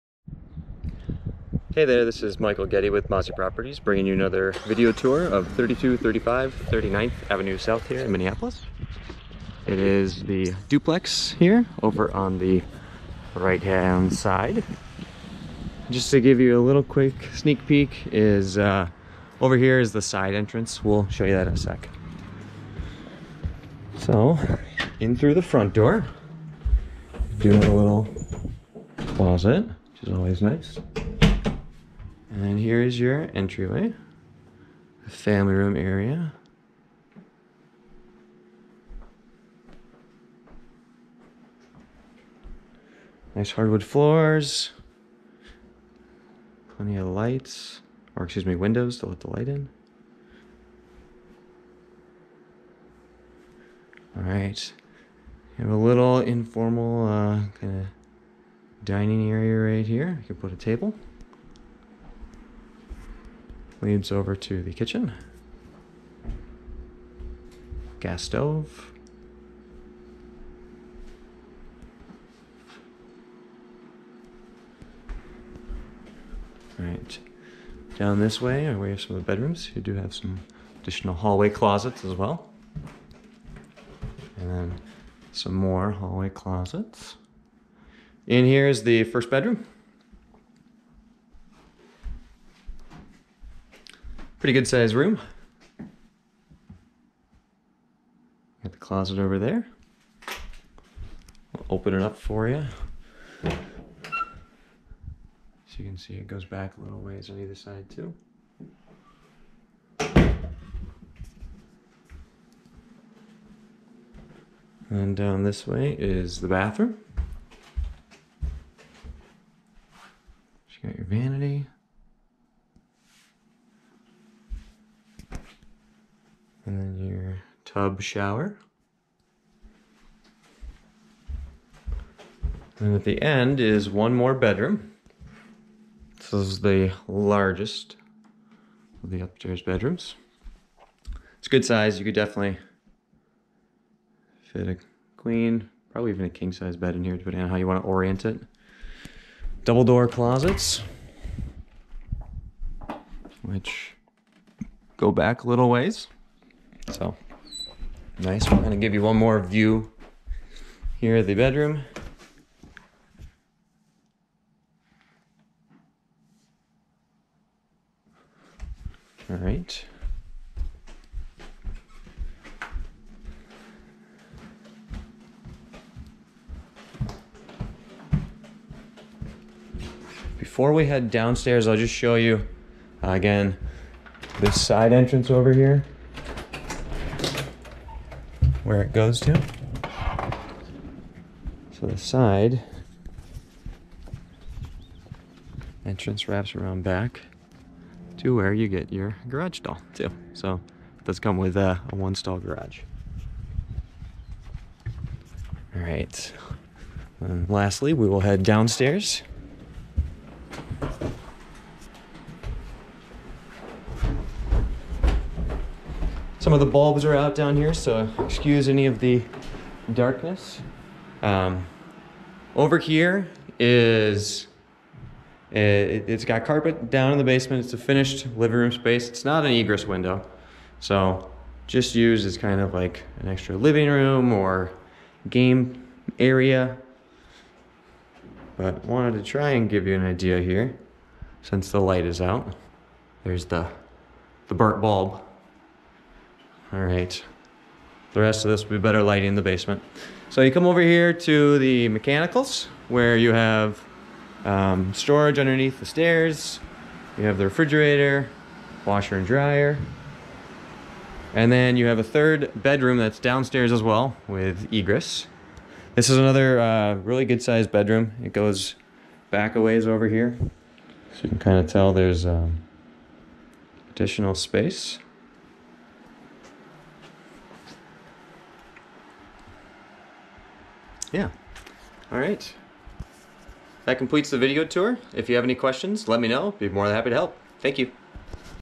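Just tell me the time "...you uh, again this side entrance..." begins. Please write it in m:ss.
3:02.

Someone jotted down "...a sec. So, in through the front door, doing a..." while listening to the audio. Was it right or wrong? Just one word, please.
right.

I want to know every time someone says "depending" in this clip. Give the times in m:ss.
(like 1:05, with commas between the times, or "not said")
2:27.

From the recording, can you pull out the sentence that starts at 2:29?
Double door closets, which go back a little ways.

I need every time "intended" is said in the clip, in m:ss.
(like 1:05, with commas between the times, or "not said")
not said.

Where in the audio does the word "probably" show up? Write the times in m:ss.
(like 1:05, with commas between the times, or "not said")
2:25.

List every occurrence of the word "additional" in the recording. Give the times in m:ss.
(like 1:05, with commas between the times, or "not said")
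1:20, 4:33.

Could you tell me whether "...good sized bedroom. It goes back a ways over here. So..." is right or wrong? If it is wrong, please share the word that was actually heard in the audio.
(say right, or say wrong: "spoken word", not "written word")
right.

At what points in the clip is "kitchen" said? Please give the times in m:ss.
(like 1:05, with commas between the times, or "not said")
1:04.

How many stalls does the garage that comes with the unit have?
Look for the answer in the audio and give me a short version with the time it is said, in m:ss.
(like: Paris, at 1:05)
1, at 3:21.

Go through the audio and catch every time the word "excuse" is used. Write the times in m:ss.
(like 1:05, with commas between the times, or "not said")
0:48, 3:38.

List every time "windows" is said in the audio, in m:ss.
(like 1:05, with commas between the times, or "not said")
0:48, 3:49.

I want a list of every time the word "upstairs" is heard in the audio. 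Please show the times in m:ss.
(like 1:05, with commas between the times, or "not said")
2:19.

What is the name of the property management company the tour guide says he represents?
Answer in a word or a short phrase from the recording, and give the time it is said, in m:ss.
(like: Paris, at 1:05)
Mazzy Properties, at 0:03.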